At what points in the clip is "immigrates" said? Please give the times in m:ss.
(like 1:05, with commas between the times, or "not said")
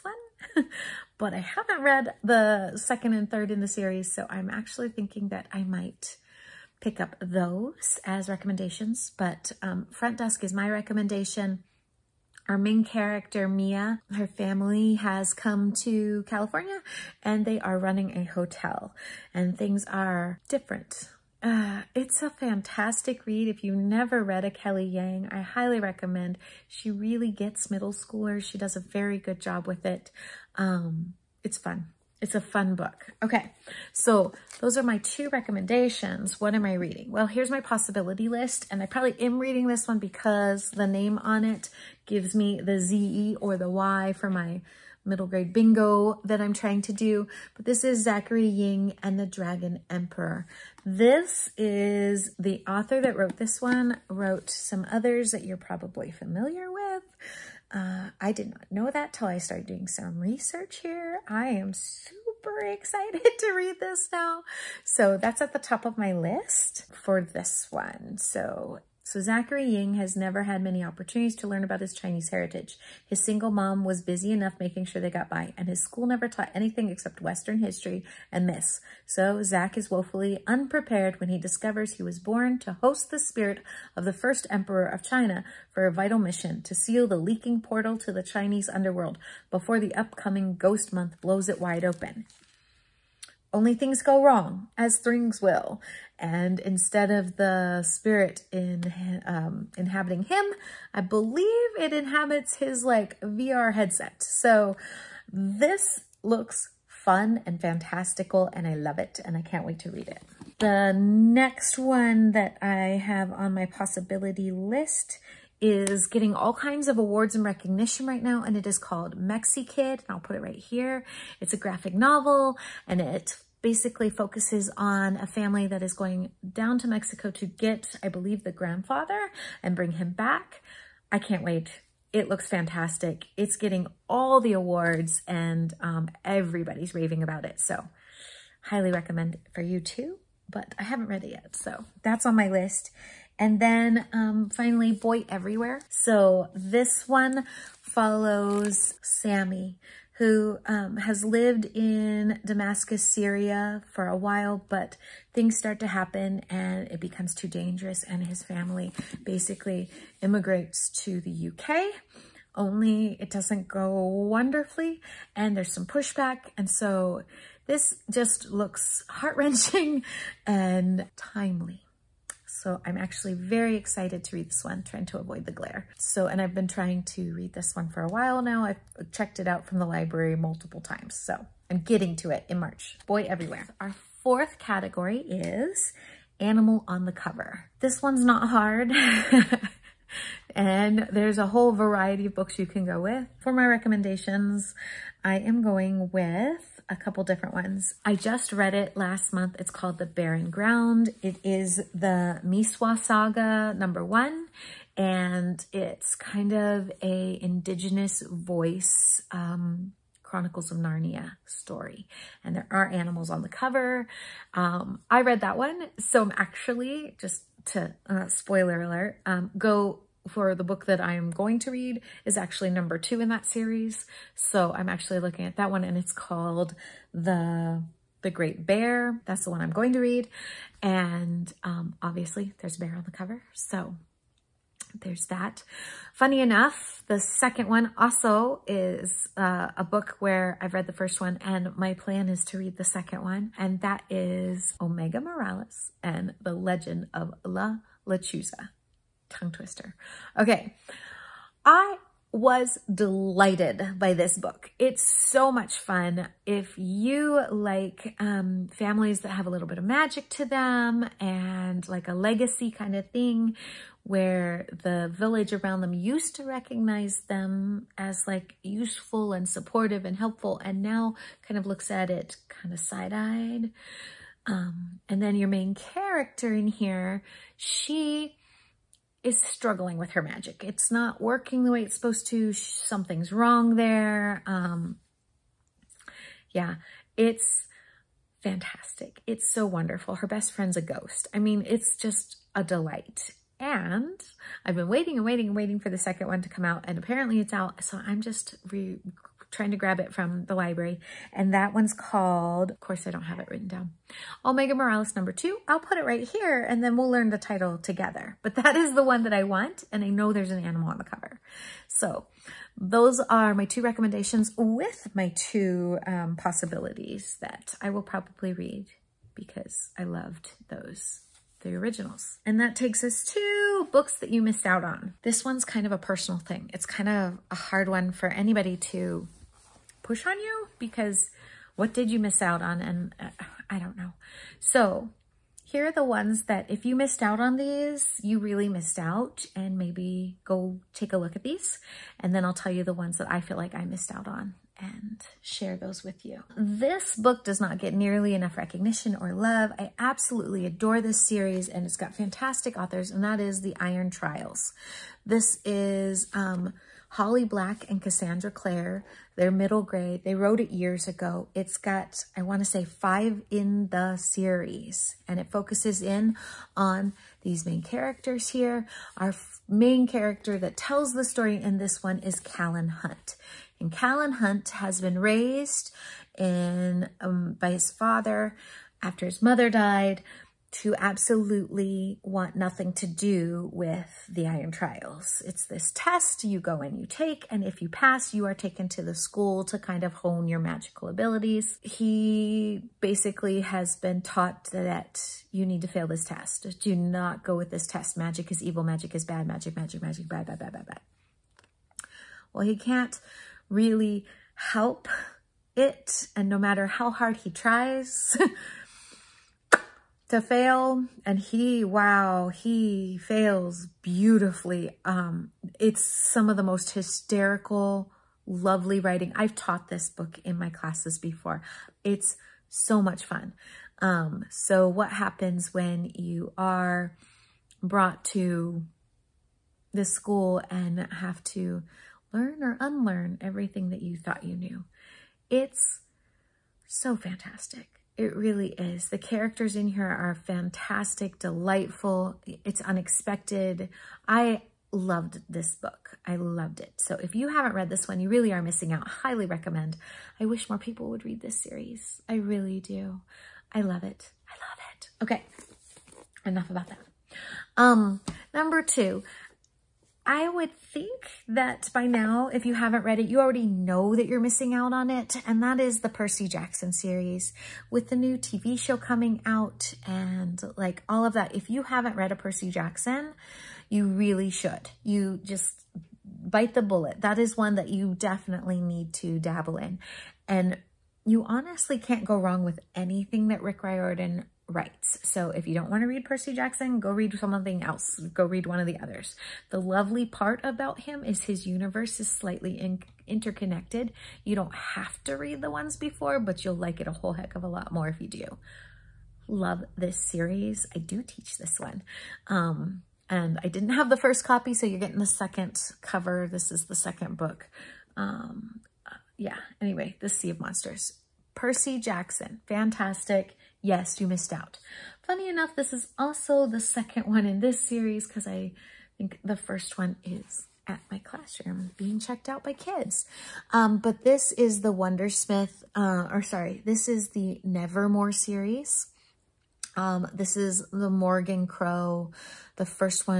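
2:40.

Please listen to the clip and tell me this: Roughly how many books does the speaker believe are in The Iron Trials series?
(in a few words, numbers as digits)
5.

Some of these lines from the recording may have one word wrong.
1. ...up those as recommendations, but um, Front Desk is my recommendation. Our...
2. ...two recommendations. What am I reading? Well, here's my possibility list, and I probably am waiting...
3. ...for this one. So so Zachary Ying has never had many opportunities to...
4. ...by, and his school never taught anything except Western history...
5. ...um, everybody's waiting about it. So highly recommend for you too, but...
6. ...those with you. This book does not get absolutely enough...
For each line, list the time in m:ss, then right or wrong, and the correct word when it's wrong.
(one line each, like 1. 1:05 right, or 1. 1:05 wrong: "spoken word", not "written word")
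1. 0:06 right
2. 0:34 wrong: "reading", not "waiting"
3. 1:06 right
4. 1:15 right
5. 2:15 wrong: "raving", not "waiting"
6. 5:45 wrong: "nearly", not "absolutely".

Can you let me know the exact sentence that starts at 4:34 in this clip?
Um, and then your main character in here, she is struggling with her magic.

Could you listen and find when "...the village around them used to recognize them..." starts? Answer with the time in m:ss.
4:24.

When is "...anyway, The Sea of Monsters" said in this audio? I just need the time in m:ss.
8:29.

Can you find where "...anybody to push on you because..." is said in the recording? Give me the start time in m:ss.
5:28.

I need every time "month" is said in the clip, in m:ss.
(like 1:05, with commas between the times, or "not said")
1:30, 3:19.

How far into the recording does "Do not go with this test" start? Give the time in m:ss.
6:36.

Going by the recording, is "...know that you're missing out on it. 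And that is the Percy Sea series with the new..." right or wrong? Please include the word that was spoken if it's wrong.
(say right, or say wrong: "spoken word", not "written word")
wrong: "Jackson", not "Sea".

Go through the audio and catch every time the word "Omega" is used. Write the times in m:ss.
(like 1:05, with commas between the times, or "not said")
4:04, 5:04.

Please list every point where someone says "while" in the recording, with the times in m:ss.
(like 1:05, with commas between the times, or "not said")
2:34, 2:58.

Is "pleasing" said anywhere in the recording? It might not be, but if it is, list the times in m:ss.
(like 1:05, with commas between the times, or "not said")
not said.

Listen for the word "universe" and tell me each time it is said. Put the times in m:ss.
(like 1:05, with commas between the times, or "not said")
8:11.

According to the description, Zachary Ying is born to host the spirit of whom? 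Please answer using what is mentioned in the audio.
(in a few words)
the first emperor of China.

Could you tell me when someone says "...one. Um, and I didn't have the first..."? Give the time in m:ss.
8:21.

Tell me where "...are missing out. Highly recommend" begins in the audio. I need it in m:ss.
7:28.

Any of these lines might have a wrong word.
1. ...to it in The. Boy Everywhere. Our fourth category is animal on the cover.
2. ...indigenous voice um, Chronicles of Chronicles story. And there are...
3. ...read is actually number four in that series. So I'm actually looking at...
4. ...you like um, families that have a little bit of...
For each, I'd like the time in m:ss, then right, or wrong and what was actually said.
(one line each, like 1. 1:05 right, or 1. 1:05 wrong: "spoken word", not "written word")
1. 3:02 wrong: "March", not "The"
2. 3:27 wrong: "Narnia", not "Chronicles"
3. 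3:41 wrong: "two", not "four"
4. 4:16 right.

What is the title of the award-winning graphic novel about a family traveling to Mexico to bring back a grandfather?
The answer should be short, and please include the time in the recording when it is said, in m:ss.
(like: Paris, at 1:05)
Mexikid, at 1:59.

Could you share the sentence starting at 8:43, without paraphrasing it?
Um, but this is the Wundersmith, uh, or sorry, this is the Nevermore series.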